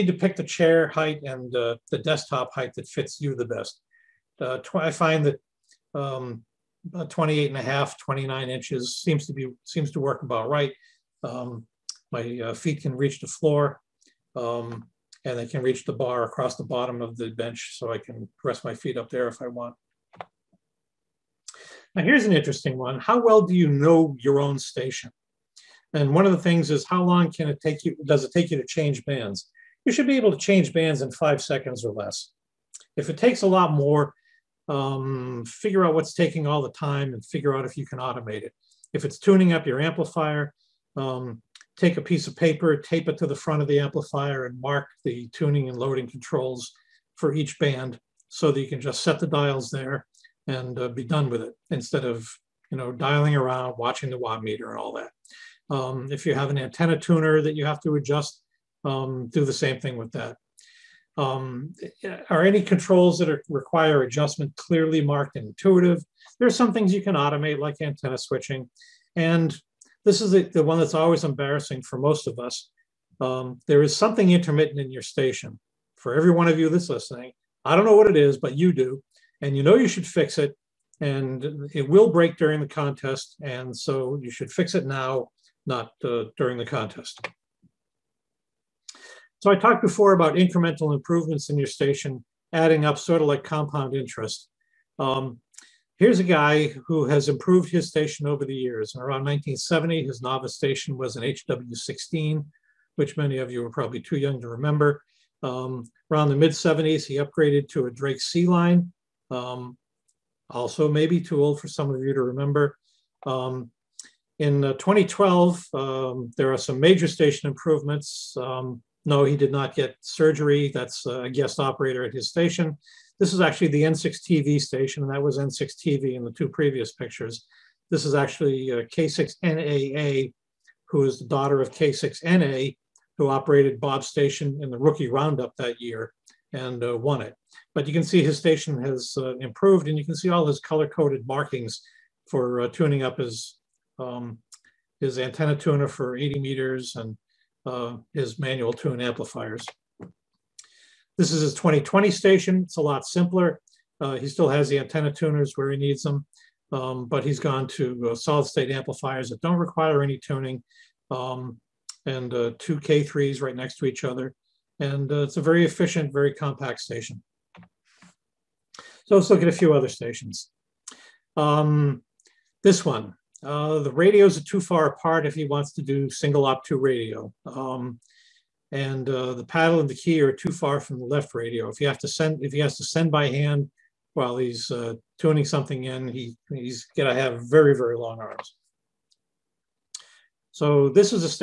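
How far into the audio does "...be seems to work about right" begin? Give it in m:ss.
0:09.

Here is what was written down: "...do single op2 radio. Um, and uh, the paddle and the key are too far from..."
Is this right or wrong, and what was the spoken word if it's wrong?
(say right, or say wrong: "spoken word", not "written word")
right.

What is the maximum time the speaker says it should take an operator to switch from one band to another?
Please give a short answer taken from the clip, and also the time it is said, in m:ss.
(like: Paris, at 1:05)
5 seconds, at 0:31.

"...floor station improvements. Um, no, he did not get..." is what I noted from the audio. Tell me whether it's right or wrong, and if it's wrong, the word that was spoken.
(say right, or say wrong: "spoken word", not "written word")
wrong: "major", not "floor".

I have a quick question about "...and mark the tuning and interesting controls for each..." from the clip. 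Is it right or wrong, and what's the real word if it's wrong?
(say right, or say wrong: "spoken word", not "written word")
wrong: "loading", not "interesting".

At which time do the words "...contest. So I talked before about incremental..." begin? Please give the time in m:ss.
1:26.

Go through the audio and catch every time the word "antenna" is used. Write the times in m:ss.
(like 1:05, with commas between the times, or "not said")
0:56, 1:07, 2:25, 2:34.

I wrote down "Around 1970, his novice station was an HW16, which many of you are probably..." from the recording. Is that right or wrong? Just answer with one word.
right.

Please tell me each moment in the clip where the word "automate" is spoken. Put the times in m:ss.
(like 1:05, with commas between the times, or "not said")
0:37, 1:07.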